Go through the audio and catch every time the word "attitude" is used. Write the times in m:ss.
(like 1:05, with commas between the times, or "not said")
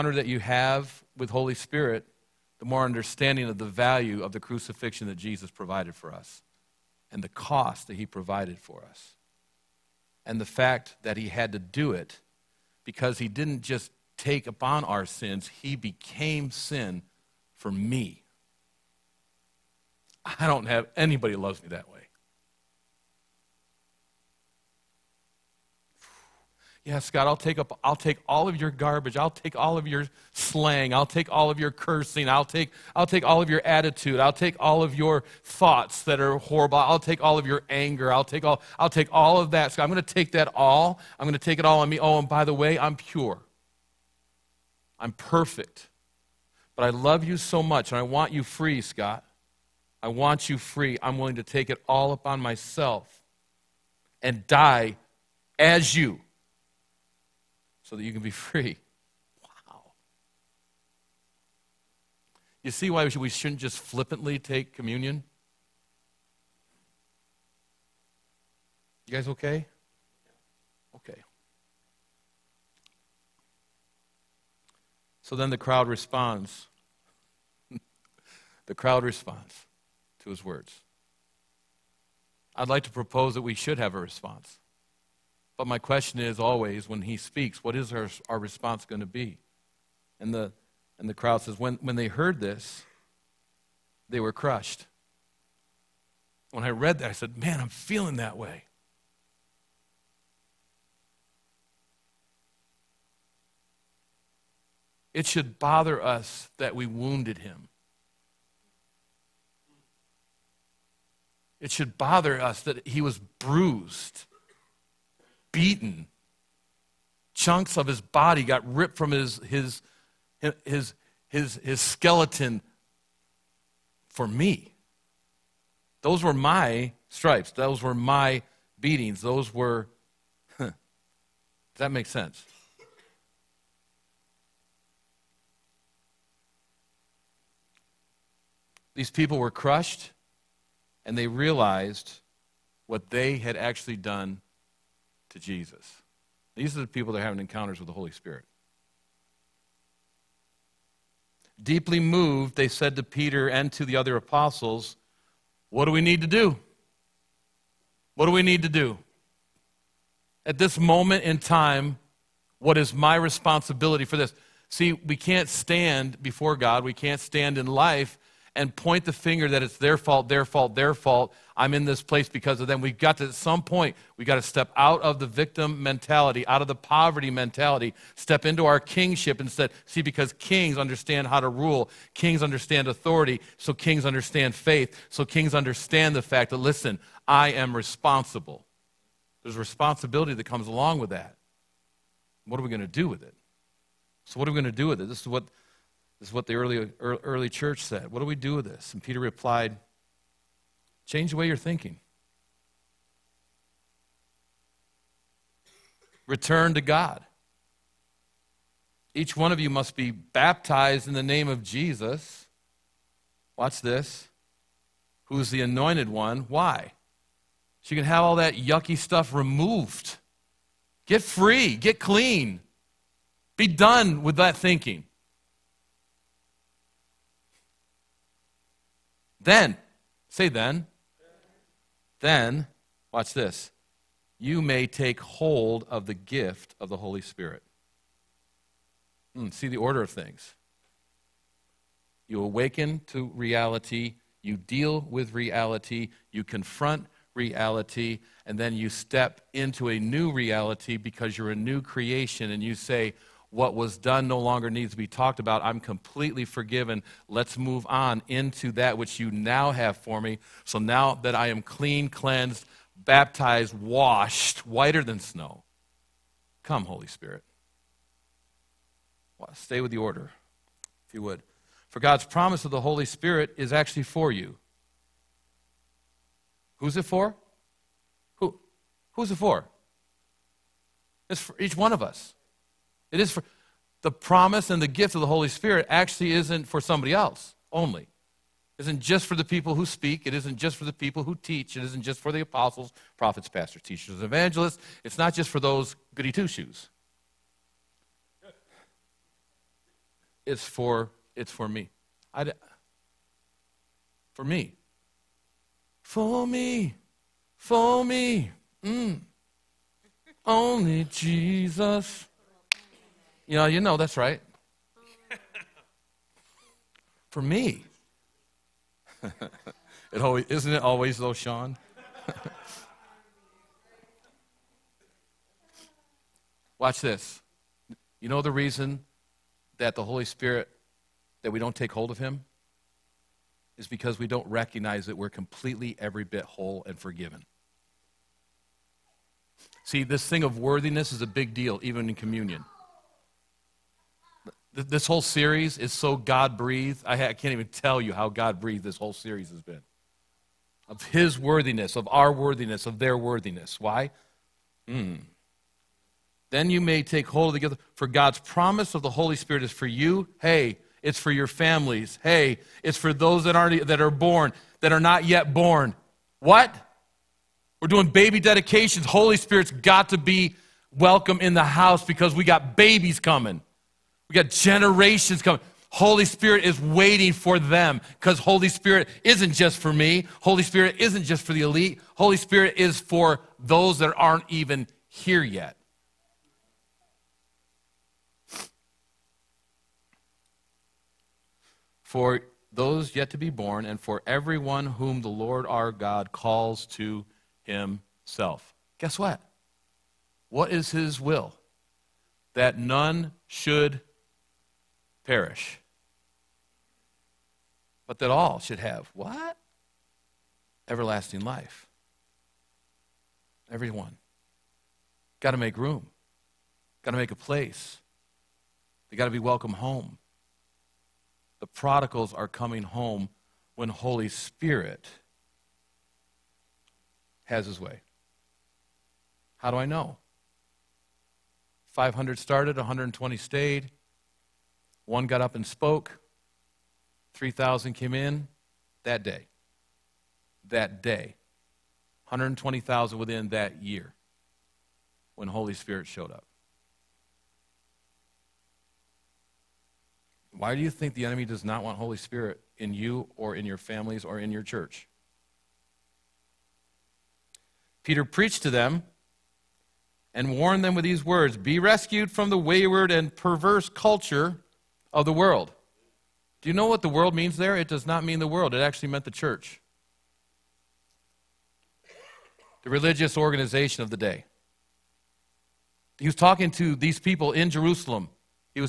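0:33.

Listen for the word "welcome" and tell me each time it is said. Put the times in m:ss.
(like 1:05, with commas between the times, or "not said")
6:10, 6:59.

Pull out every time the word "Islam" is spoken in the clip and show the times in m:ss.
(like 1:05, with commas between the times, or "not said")
not said.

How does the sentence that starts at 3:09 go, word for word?
There's responsibility that comes along with that.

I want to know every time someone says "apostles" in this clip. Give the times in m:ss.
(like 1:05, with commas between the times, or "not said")
2:34, 4:52.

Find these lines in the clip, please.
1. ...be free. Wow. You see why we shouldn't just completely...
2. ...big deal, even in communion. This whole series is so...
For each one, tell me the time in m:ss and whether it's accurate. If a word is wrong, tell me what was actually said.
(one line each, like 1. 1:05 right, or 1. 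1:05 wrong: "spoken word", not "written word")
1. 0:58 wrong: "flippantly", not "completely"
2. 5:41 right.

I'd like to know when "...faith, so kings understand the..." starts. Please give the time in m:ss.
3:04.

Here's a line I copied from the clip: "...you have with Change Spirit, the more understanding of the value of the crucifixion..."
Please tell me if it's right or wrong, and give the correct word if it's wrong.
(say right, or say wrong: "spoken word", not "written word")
wrong: "Holy", not "Change".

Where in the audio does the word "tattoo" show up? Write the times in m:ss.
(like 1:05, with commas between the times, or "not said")
not said.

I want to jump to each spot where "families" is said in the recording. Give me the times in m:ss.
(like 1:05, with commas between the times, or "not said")
6:01, 7:33.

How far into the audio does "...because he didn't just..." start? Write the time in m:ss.
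0:12.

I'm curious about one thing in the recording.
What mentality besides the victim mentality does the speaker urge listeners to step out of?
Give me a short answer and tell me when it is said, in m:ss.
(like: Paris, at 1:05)
poverty mentality, at 2:56.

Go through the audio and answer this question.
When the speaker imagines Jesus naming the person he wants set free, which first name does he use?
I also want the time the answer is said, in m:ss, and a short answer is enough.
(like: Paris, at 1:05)
Scott, at 0:48.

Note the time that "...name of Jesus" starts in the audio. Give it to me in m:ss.
3:31.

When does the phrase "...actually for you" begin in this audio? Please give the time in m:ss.
4:33.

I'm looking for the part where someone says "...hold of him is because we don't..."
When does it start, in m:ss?
5:31.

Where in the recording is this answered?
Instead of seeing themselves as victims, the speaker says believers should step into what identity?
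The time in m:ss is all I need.
2:58.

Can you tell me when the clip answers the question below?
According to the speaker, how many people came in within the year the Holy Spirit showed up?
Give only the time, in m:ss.
7:22.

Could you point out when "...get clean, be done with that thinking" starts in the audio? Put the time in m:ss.
3:41.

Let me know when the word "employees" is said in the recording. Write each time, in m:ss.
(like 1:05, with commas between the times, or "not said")
not said.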